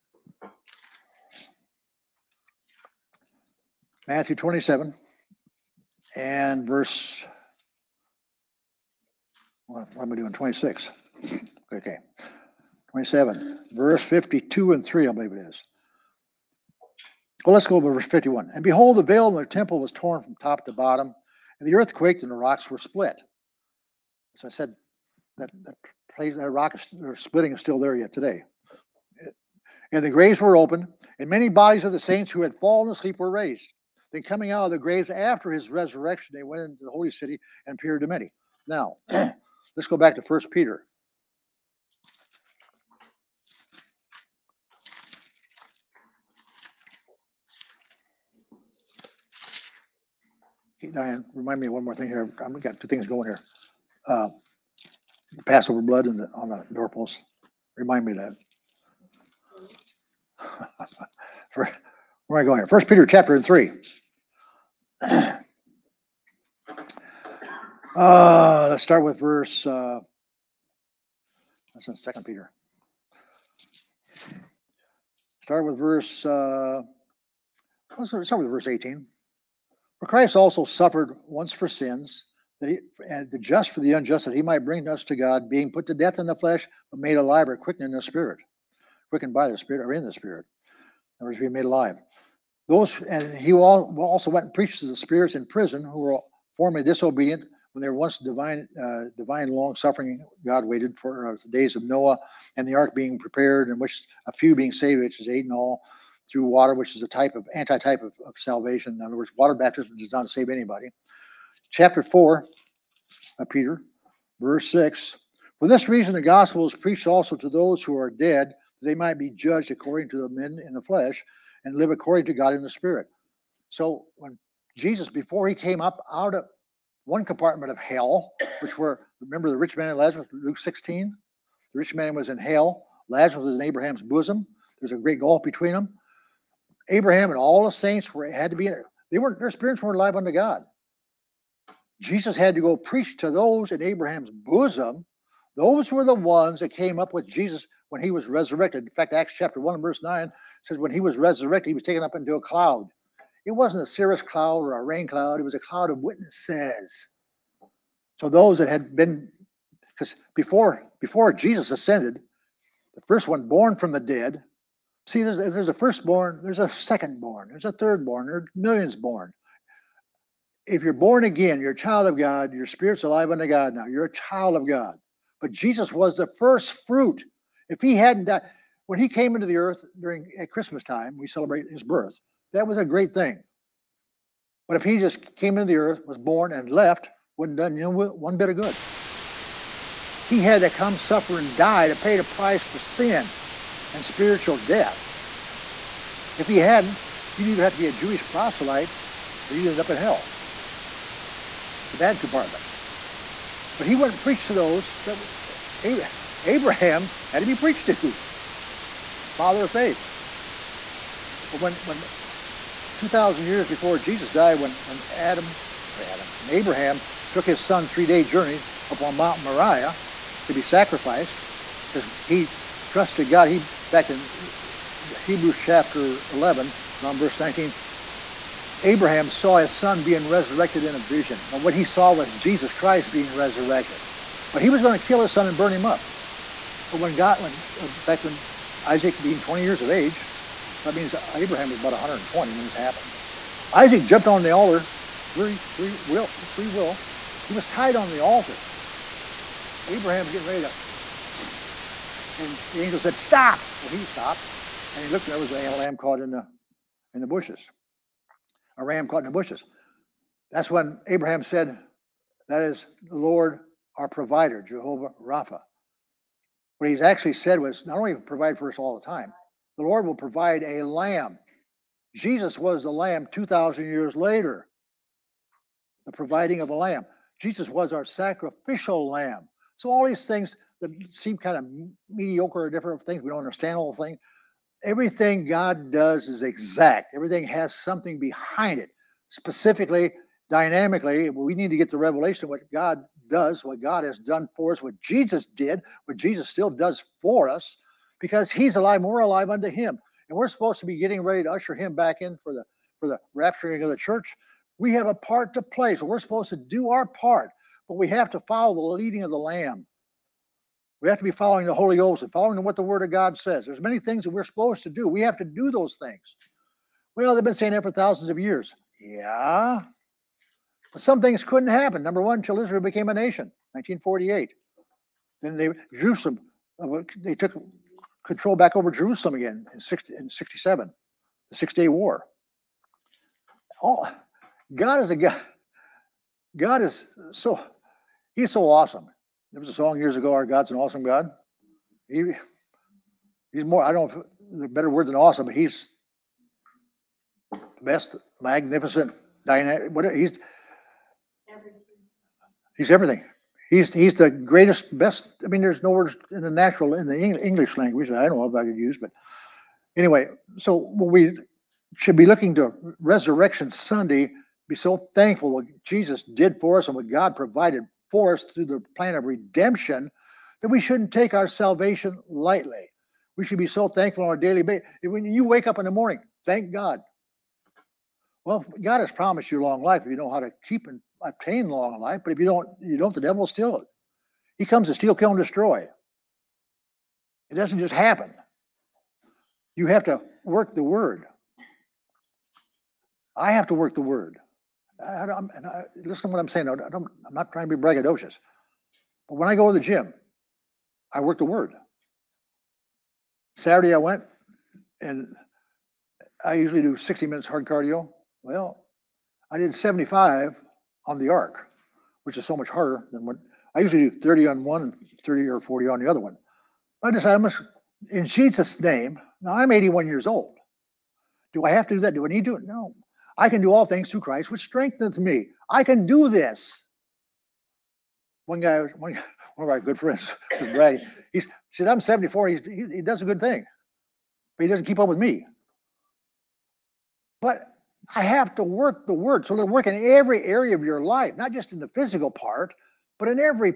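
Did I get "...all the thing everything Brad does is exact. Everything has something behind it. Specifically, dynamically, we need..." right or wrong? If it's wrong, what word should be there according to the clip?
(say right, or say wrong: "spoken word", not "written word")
wrong: "God", not "Brad".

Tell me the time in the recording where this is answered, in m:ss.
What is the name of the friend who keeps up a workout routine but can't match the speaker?
7:10.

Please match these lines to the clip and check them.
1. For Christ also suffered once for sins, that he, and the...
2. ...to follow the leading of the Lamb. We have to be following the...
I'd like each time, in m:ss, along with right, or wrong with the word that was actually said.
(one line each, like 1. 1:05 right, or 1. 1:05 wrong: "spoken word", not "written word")
1. 1:20 right
2. 5:08 right.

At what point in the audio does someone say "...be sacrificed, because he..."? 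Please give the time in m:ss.
3:40.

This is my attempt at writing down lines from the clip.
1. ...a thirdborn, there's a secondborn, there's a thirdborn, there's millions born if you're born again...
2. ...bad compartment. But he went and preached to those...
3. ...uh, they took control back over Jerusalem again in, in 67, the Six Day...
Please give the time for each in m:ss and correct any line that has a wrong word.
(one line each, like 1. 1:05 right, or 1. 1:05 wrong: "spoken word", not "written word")
1. 2:45 wrong: "firstborn", not "thirdborn"
2. 3:21 right
3. 5:26 right.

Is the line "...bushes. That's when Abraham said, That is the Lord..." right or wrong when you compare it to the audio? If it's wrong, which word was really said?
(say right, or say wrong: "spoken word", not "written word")
right.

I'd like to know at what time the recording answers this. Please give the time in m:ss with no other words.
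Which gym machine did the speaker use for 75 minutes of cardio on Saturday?
6:51.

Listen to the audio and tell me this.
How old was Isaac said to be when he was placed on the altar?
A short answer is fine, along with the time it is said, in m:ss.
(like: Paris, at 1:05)
20, at 3:59.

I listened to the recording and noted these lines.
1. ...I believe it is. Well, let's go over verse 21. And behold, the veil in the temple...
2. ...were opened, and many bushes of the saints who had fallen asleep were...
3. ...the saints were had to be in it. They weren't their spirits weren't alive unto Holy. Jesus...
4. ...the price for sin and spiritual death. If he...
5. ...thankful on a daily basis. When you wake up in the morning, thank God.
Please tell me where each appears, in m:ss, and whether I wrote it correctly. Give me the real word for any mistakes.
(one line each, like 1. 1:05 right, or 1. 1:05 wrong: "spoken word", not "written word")
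1. 0:15 wrong: "51", not "21"
2. 0:30 wrong: "bodies", not "bushes"
3. 2:17 wrong: "God", not "Holy"
4. 3:12 right
5. 6:13 right.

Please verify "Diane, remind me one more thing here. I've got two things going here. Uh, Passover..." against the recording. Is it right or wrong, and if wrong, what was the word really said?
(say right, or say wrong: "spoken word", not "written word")
right.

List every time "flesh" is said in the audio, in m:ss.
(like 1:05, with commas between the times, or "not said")
1:26, 2:00.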